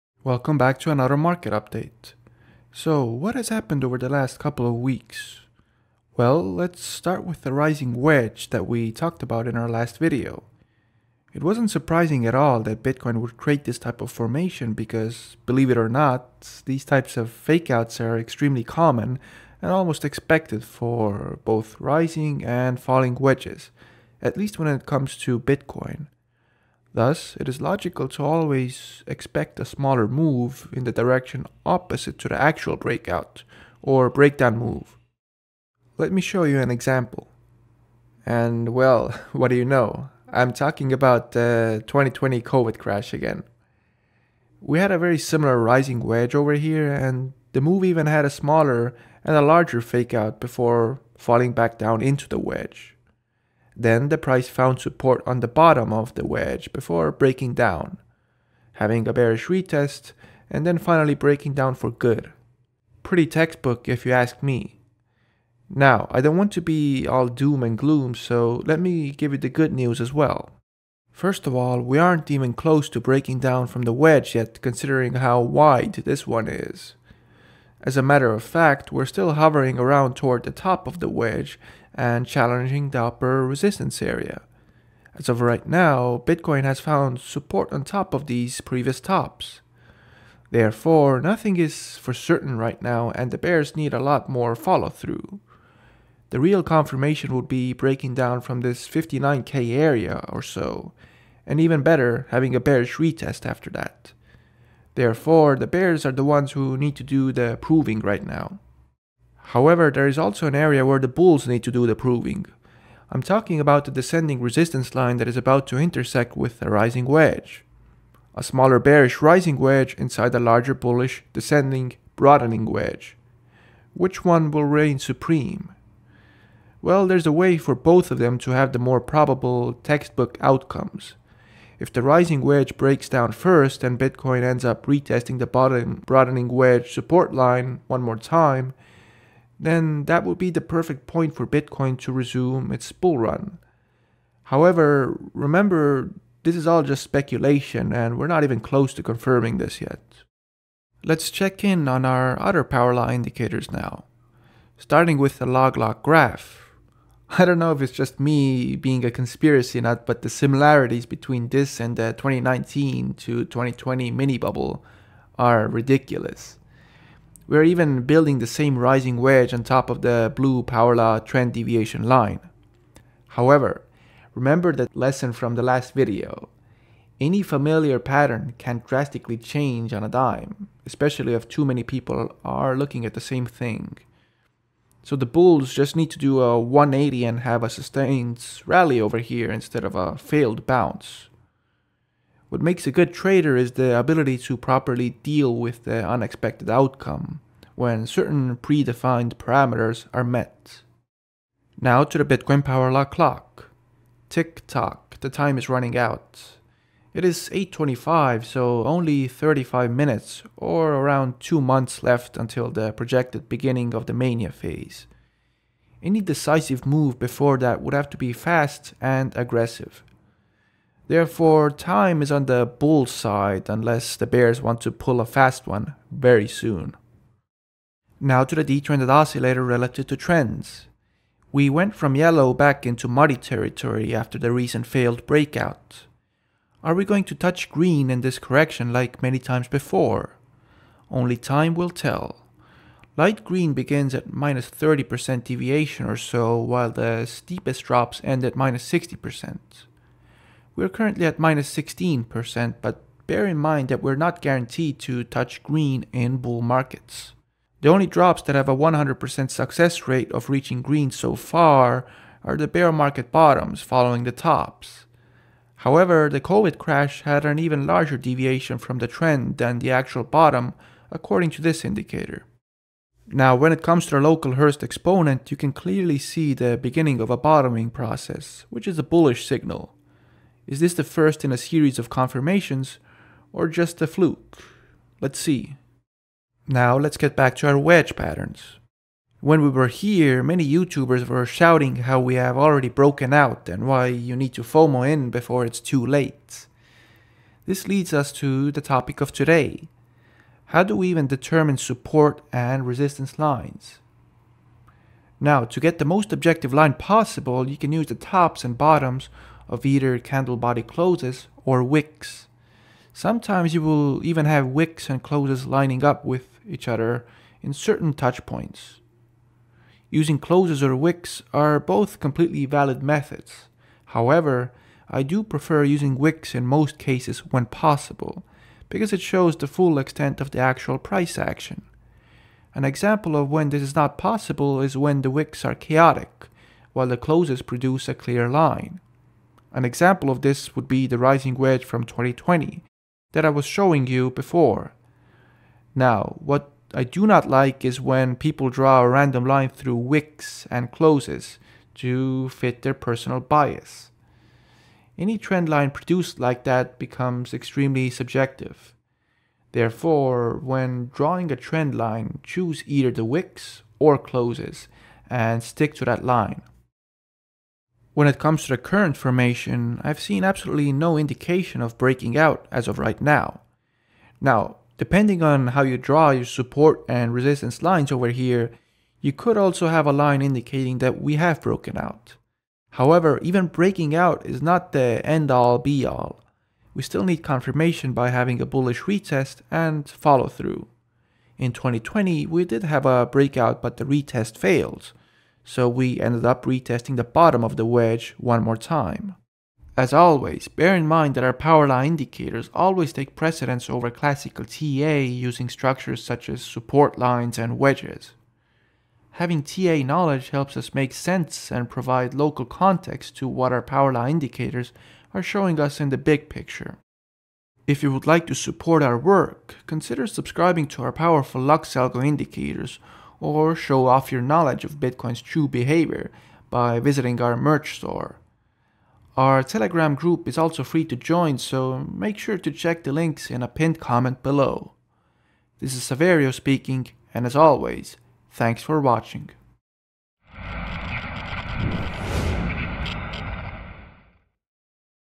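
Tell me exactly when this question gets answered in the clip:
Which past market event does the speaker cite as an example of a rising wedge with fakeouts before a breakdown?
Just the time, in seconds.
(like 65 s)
41 s.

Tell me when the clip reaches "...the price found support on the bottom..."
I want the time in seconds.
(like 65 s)
54 s.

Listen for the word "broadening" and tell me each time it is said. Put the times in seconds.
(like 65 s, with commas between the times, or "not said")
122 s, 136 s.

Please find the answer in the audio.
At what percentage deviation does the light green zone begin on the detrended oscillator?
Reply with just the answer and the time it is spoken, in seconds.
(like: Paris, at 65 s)
-30%, at 244 s.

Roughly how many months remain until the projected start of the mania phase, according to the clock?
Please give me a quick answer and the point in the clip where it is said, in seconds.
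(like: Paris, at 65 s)
2 months, at 211 s.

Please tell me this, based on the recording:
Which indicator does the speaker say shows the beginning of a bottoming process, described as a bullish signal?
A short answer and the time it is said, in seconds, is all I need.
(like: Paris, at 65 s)
local Hurst exponent, at 274 s.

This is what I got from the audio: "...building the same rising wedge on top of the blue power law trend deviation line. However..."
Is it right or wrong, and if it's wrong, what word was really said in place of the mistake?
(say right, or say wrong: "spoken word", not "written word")
right.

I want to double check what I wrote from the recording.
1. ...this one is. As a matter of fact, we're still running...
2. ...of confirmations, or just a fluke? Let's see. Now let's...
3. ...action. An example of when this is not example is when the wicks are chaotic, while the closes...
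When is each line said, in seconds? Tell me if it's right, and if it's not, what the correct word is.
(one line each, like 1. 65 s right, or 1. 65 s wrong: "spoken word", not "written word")
1. 75 s wrong: "hovering", not "running"
2. 281 s right
3. 331 s wrong: "possible", not "example".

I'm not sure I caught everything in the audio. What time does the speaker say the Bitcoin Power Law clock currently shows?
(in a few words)
8.25.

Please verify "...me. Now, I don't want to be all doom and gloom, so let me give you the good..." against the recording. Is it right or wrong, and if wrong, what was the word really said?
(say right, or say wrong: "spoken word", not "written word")
right.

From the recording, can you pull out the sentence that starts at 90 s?
Therefore, nothing is for certain right now and the bears need a lot more follow through.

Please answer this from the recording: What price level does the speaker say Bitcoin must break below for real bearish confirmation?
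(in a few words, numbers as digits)
59k.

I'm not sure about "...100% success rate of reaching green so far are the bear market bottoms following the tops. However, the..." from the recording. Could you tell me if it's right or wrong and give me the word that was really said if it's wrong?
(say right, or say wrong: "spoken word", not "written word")
right.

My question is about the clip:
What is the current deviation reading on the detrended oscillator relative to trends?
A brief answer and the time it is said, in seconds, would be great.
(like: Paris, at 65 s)
-16%, at 251 s.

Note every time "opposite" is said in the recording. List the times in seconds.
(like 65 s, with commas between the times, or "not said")
31 s.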